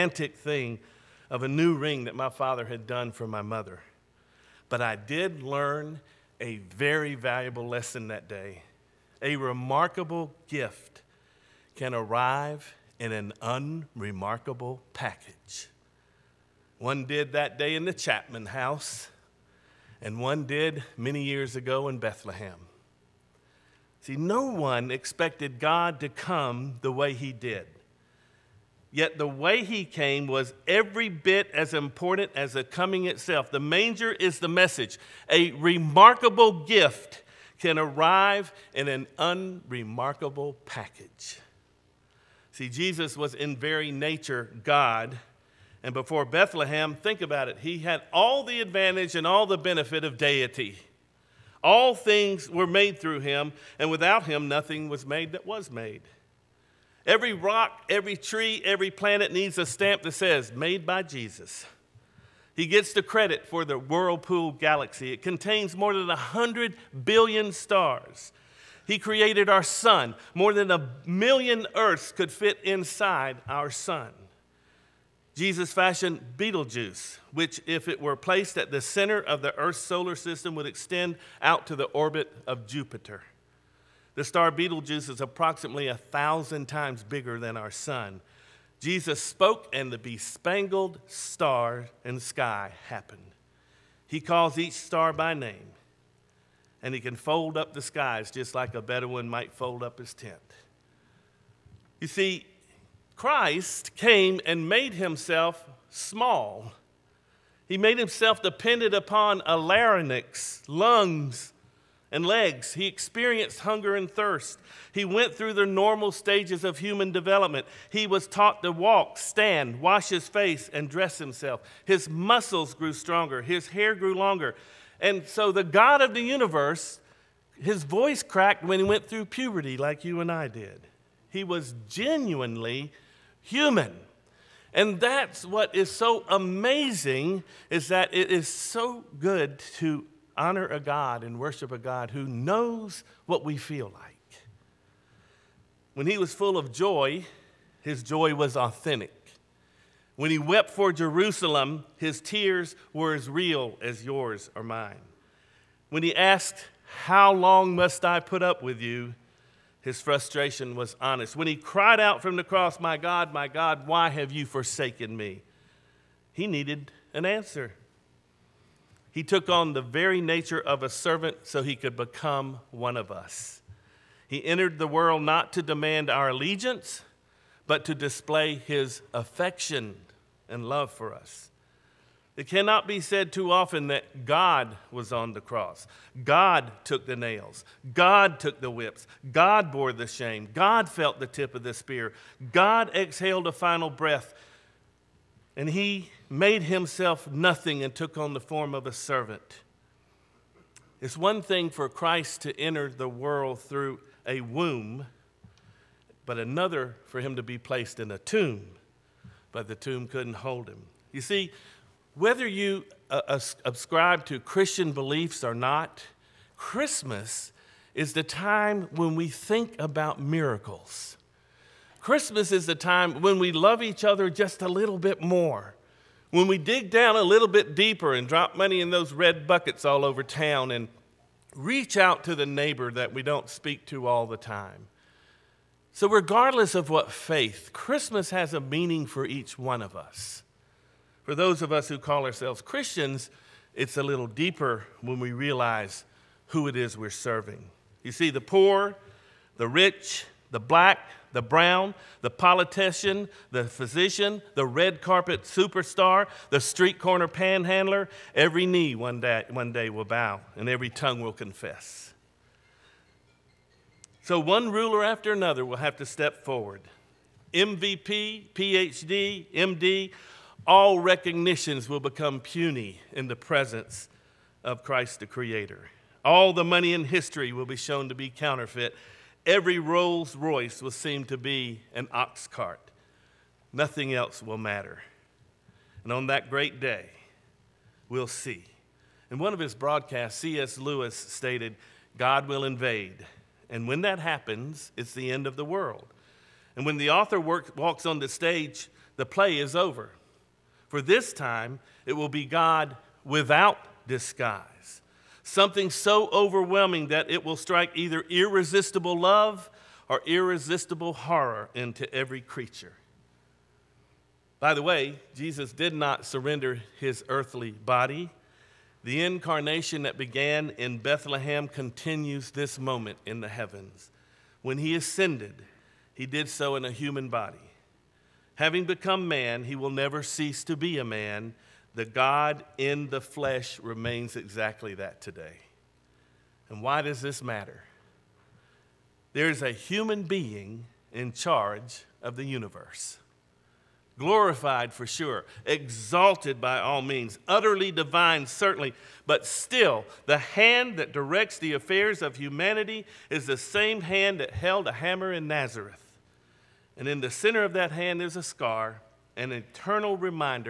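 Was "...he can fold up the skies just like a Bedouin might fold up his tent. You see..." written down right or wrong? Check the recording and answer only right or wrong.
right.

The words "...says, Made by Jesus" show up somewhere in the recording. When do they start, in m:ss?
1:00.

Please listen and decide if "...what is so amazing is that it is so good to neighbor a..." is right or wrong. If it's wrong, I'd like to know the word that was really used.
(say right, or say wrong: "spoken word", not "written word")
wrong: "honor", not "neighbor".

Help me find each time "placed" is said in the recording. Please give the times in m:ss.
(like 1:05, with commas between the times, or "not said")
1:18, 3:27.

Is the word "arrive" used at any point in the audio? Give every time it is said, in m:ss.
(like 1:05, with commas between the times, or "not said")
0:11, 0:37.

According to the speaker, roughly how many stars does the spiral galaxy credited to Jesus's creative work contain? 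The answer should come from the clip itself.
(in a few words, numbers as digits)
more than 100 billion.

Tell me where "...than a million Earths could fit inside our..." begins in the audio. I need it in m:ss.
1:10.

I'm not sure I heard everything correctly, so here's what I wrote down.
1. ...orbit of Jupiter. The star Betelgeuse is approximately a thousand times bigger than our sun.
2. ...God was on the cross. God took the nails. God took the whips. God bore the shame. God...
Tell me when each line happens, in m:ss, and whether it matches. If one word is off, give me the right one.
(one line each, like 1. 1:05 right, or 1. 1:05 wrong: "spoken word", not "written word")
1. 1:21 right
2. 3:04 right.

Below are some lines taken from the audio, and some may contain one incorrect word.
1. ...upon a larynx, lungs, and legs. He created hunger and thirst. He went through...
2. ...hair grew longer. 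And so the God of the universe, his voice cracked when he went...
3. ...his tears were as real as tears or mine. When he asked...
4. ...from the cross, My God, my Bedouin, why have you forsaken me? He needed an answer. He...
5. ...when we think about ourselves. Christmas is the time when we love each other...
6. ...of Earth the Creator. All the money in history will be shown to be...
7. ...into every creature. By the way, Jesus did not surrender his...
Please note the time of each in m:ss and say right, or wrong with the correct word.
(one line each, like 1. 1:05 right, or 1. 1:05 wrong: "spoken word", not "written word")
1. 1:48 wrong: "experienced", not "created"
2. 2:03 right
3. 2:31 wrong: "yours", not "tears"
4. 2:42 wrong: "God", not "Bedouin"
5. 3:38 wrong: "miracles", not "ourselves"
6. 4:34 wrong: "Christ", not "Earth"
7. 5:11 right.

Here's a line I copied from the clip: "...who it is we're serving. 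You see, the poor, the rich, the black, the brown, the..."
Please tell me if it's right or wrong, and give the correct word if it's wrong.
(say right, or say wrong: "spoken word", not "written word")
right.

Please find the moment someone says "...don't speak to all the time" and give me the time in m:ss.
3:53.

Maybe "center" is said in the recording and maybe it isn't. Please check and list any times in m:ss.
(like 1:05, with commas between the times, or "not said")
1:18, 5:57.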